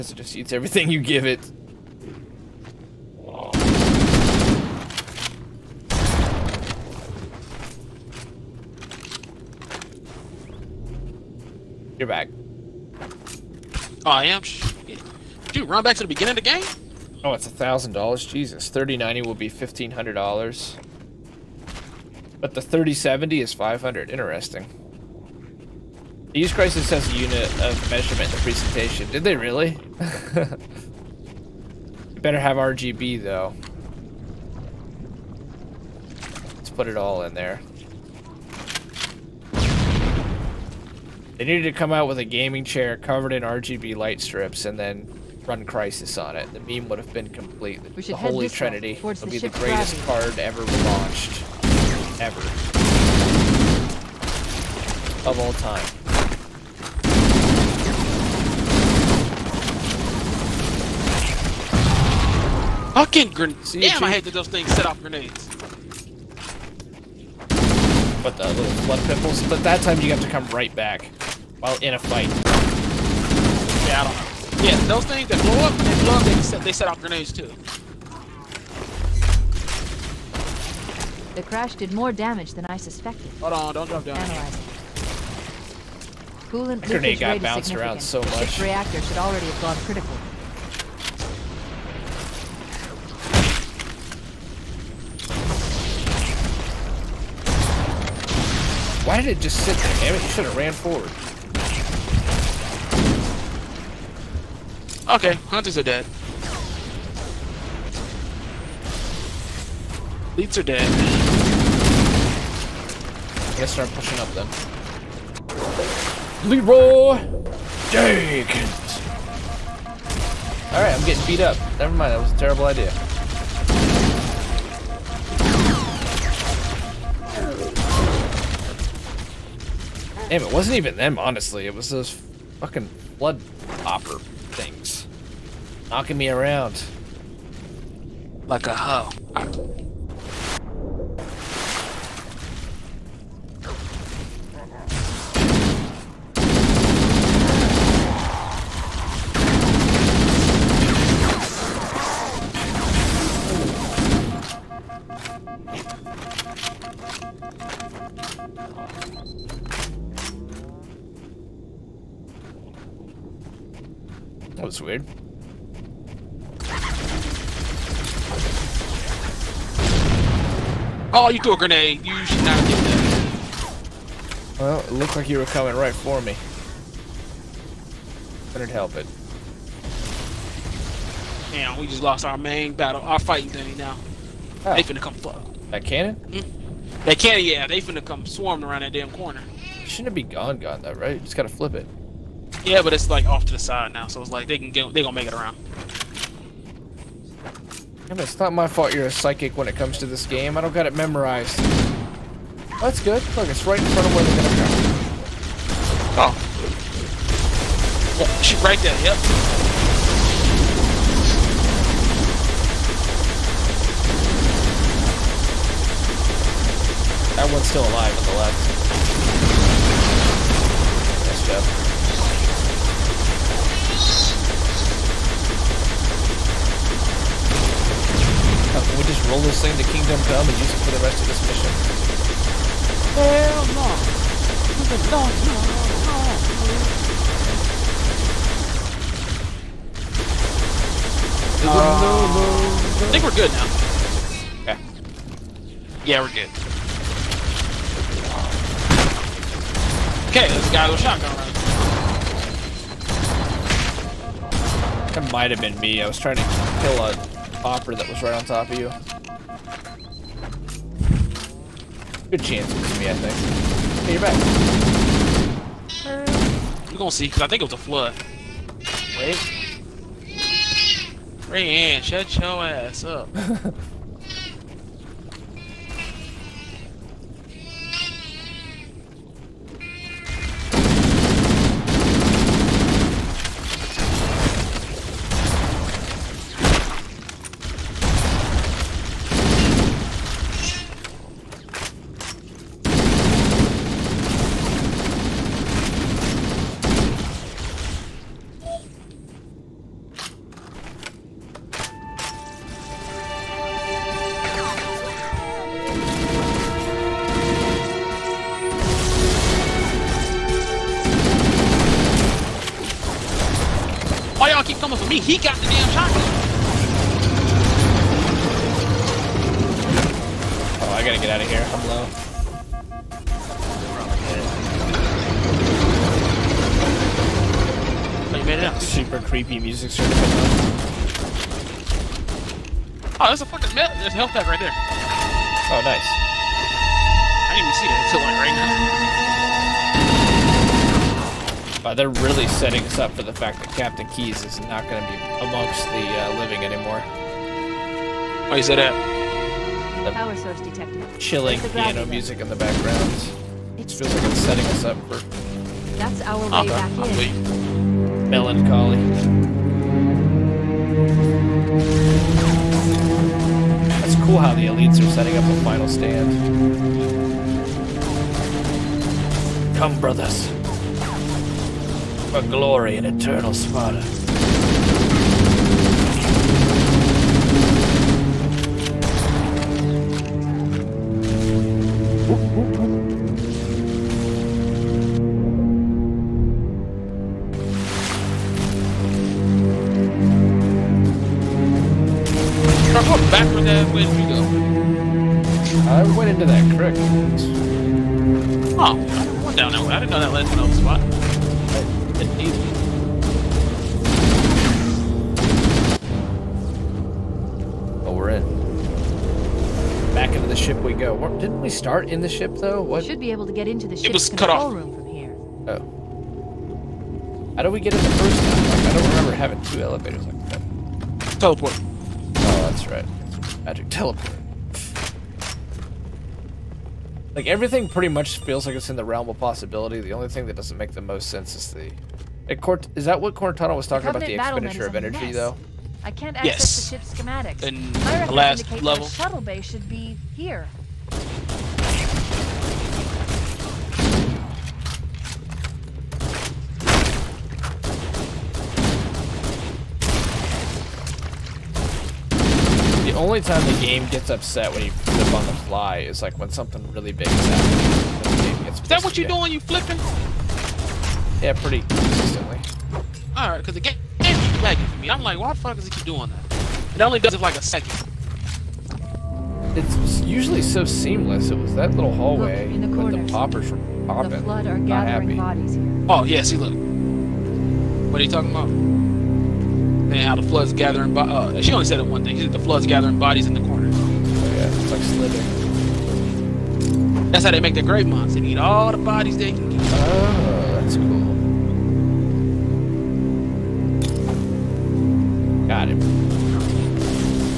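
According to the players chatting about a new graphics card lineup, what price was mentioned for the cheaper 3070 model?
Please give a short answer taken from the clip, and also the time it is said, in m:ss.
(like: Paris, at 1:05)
$500, at 0:23.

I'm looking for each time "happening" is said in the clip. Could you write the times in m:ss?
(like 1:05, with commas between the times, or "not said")
7:37.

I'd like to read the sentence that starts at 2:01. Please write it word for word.
Never mind, that was a terrible idea.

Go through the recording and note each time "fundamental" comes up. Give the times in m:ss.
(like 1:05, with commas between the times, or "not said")
not said.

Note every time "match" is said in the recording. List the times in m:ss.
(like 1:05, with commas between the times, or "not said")
not said.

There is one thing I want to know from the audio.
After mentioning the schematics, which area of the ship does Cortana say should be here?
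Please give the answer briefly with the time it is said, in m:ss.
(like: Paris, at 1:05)
Shuttle bay, at 7:19.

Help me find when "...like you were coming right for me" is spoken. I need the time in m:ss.
2:55.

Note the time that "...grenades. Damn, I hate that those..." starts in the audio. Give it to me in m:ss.
1:03.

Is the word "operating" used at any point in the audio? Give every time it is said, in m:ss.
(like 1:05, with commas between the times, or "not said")
not said.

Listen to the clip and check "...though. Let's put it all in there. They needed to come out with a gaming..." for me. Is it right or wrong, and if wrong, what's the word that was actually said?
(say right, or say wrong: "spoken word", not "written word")
right.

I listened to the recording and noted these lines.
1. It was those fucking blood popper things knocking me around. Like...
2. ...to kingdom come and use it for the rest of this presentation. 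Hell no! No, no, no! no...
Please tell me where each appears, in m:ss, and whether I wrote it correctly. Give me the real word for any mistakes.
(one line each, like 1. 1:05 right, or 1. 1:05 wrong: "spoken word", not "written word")
1. 2:11 right
2. 3:49 wrong: "mission", not "presentation".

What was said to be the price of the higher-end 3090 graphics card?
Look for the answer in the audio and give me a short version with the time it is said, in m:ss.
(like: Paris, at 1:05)
$1500, at 0:19.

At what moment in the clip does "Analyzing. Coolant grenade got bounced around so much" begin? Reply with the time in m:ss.
1:24.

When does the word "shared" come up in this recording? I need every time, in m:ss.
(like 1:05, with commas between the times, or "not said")
not said.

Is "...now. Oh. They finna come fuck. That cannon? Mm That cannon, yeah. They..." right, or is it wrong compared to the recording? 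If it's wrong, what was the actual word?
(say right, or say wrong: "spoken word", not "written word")
right.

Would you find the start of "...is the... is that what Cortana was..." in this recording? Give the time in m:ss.
7:11.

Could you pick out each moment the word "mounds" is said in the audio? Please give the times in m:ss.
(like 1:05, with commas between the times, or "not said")
8:08.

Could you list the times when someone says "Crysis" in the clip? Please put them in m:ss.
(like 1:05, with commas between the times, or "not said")
0:26, 0:45.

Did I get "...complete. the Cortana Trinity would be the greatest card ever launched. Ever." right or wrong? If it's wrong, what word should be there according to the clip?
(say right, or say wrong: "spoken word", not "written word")
wrong: "Holy", not "Cortana".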